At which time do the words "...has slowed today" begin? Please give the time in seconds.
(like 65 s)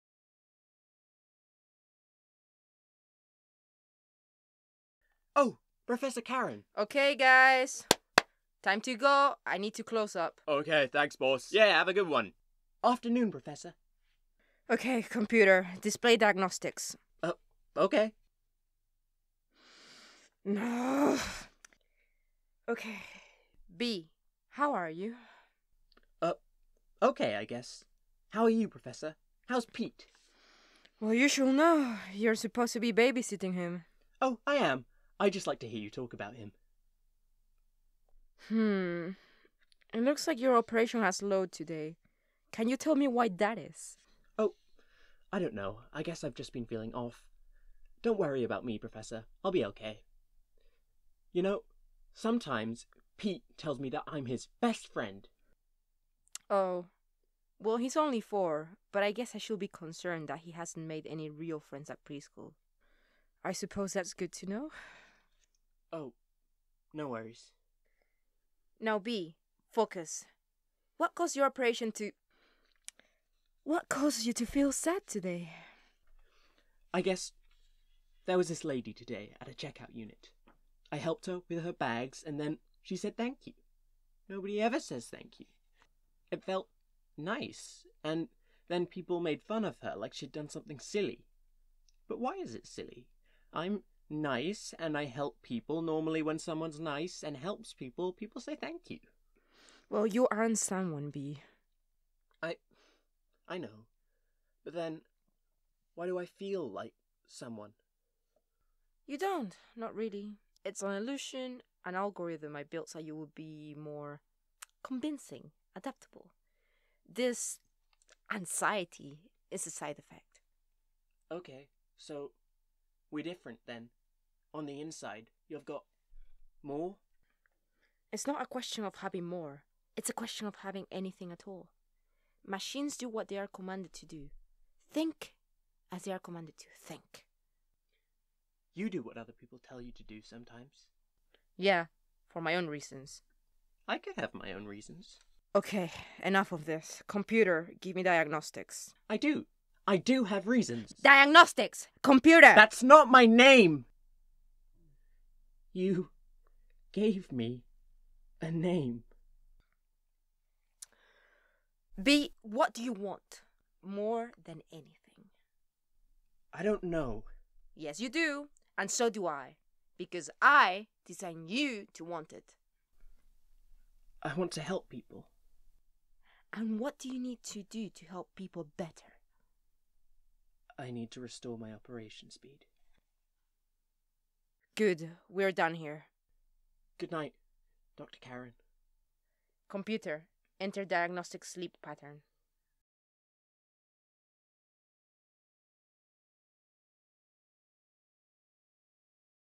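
41 s.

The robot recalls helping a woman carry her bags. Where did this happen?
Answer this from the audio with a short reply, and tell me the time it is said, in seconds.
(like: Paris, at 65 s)
a checkout unit, at 79 s.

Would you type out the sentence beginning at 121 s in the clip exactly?
Okay, so we're different then on the inside, you've got more.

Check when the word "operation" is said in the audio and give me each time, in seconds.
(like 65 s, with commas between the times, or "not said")
40 s, 71 s, 181 s.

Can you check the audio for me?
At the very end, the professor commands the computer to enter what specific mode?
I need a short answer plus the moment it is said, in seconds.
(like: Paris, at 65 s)
diagnostic sleep pattern, at 190 s.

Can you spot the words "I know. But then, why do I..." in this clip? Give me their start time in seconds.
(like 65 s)
103 s.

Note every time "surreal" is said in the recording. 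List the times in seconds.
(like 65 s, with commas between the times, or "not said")
not said.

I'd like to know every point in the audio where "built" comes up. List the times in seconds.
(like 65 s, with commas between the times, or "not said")
112 s.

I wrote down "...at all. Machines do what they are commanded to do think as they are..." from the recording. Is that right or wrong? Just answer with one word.
right.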